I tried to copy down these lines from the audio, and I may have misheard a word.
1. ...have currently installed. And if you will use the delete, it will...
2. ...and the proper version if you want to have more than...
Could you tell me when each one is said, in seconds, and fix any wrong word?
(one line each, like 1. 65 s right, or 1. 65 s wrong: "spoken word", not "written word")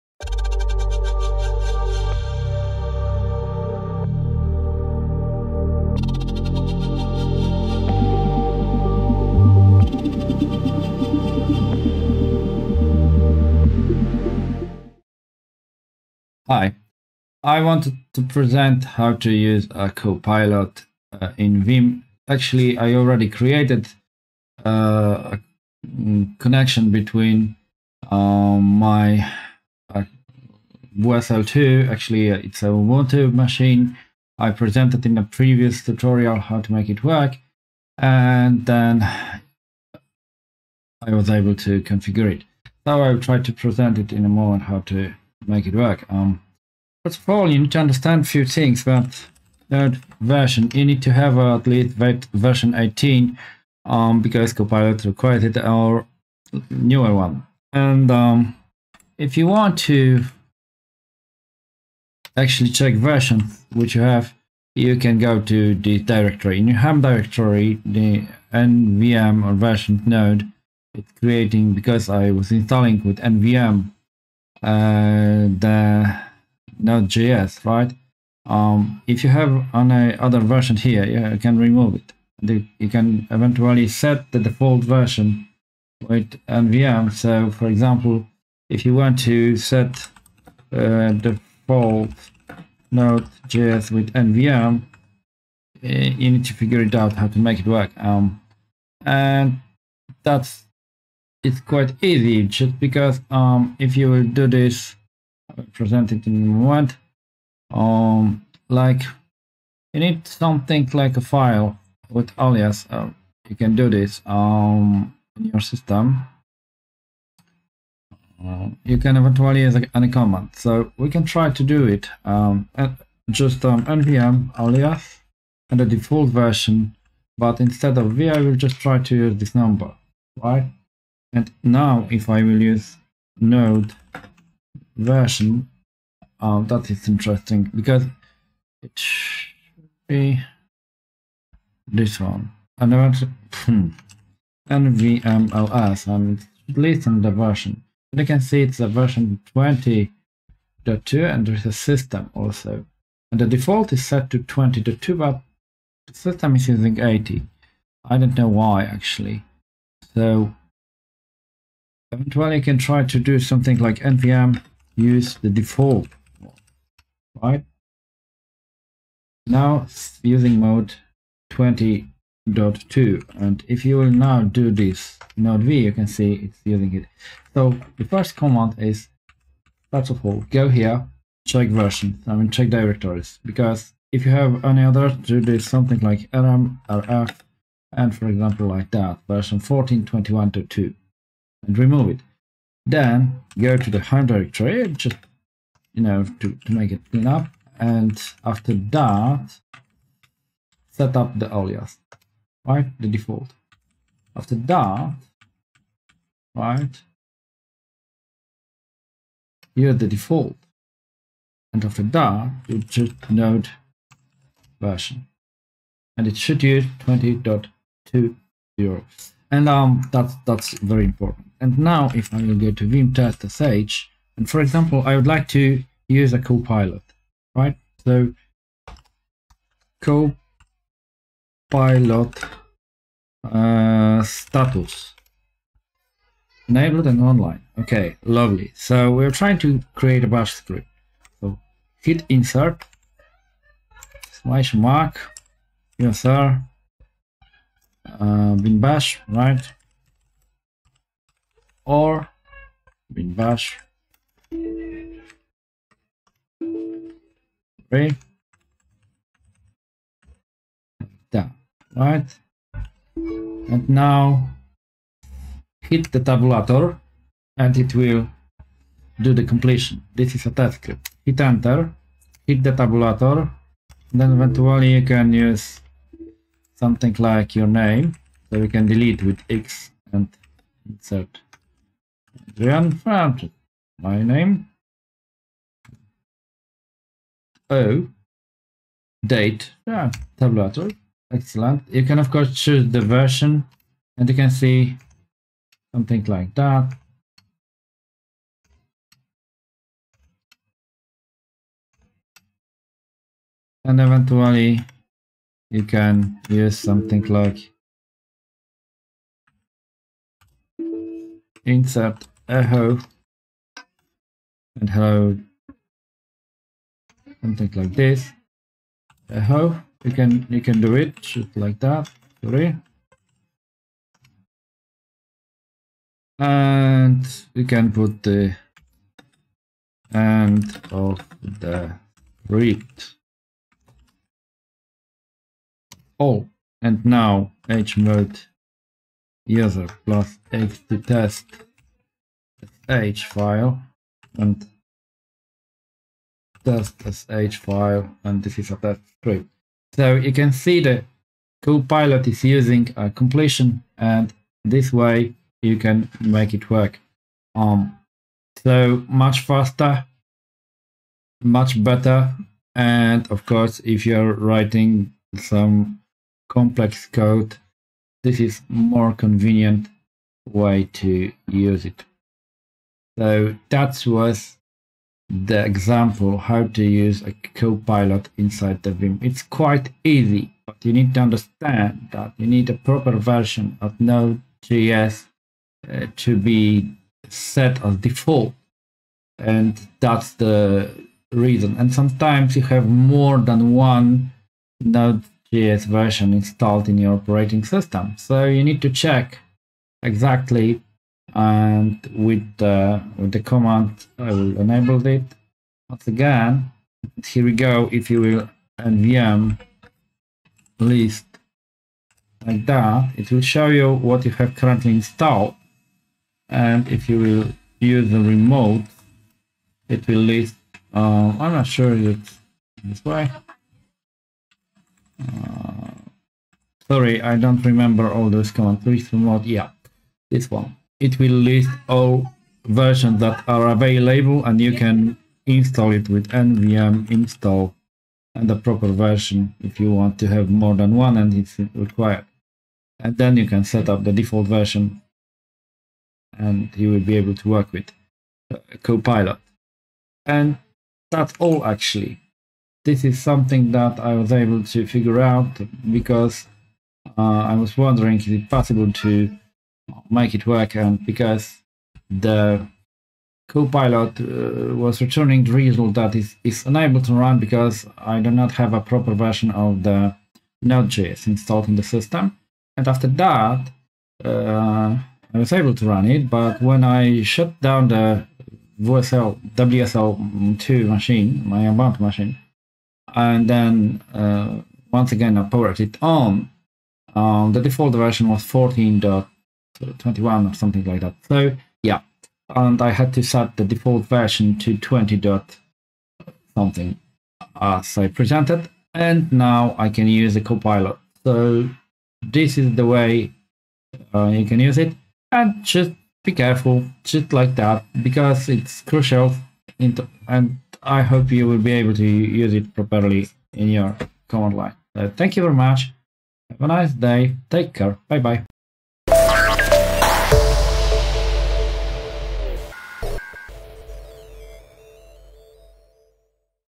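1. 414 s wrong: "remote", not "delete"
2. 438 s right.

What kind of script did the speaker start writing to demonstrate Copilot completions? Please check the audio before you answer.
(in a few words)
bash script.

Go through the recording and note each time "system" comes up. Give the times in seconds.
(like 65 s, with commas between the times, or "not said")
115 s, 151 s, 156 s, 397 s, 471 s.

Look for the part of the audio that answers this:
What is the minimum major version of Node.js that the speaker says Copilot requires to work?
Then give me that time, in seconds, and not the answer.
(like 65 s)
51 s.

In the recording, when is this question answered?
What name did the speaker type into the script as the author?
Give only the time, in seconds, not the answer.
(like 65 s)
282 s.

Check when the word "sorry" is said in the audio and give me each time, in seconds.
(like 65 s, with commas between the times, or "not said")
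322 s, 426 s.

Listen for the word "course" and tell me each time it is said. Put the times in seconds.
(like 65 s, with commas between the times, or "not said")
292 s, 363 s.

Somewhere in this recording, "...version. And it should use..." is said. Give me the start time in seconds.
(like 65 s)
214 s.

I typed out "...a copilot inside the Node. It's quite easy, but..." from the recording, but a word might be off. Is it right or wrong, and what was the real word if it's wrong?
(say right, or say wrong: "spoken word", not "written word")
wrong: "Vim", not "Node".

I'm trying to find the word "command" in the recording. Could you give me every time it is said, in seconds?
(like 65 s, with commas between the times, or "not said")
120 s, 178 s, 403 s, 428 s, 514 s.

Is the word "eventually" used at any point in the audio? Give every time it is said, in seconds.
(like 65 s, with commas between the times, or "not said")
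83 s, 119 s, 162 s, 274 s, 304 s.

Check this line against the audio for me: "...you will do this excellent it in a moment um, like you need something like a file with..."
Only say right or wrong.
wrong.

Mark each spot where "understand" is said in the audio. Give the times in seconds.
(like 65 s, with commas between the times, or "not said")
47 s, 381 s.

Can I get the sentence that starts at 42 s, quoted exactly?
Now I'll try to present it in a moment how to make it work.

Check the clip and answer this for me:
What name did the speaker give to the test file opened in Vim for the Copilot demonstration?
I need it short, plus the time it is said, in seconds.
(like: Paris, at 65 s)
test sh, at 223 s.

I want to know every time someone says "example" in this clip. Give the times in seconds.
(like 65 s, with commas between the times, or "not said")
87 s, 188 s, 224 s, 375 s.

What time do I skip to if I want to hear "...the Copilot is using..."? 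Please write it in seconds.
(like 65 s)
350 s.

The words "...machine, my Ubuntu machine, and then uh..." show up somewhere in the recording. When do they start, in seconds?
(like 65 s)
480 s.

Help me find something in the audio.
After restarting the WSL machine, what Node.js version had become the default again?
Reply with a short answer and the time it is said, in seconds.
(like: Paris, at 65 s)
14.21, at 488 s.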